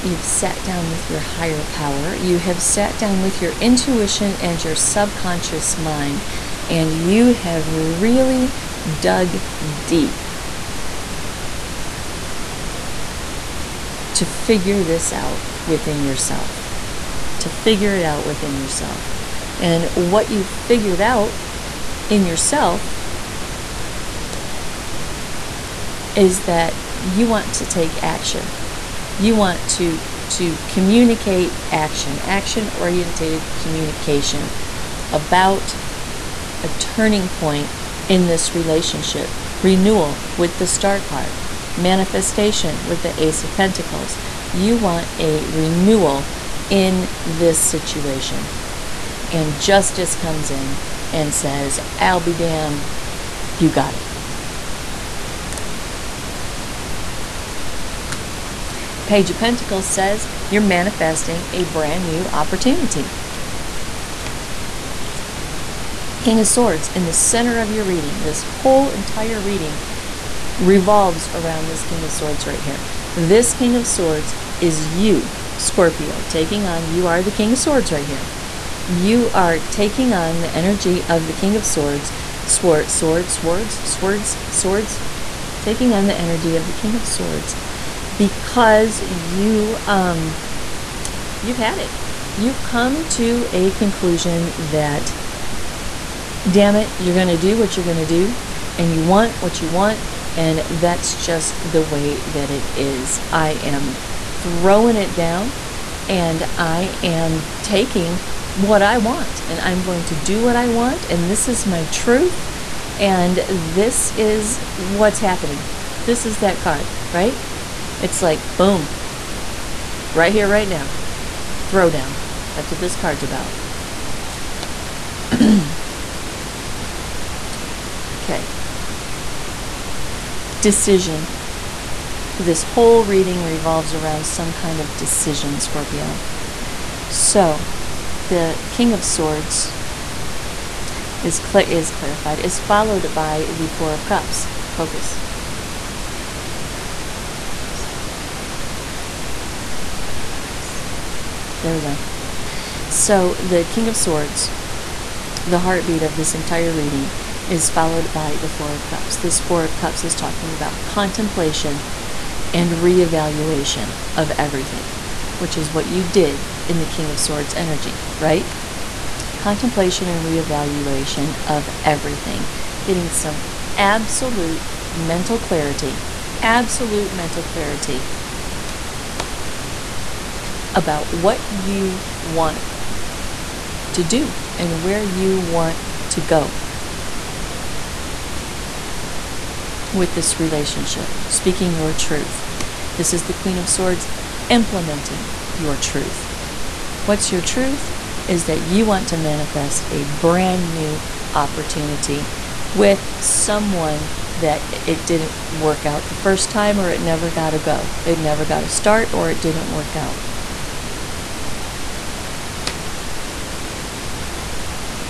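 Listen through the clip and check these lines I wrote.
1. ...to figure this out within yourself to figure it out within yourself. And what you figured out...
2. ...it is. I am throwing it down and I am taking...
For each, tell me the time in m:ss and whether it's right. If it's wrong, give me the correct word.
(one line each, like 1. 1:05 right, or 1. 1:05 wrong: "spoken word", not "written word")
1. 0:14 right
2. 1:42 right.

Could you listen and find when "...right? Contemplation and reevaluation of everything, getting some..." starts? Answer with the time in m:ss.
2:48.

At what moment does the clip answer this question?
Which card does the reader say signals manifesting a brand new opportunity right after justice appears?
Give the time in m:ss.
0:59.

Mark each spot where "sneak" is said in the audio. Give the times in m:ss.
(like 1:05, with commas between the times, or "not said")
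not said.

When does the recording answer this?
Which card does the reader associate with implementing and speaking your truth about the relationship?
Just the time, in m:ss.
3:13.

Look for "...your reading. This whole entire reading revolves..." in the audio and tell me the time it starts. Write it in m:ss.
1:07.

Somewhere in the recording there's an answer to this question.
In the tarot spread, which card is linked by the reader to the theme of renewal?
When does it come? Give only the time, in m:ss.
0:40.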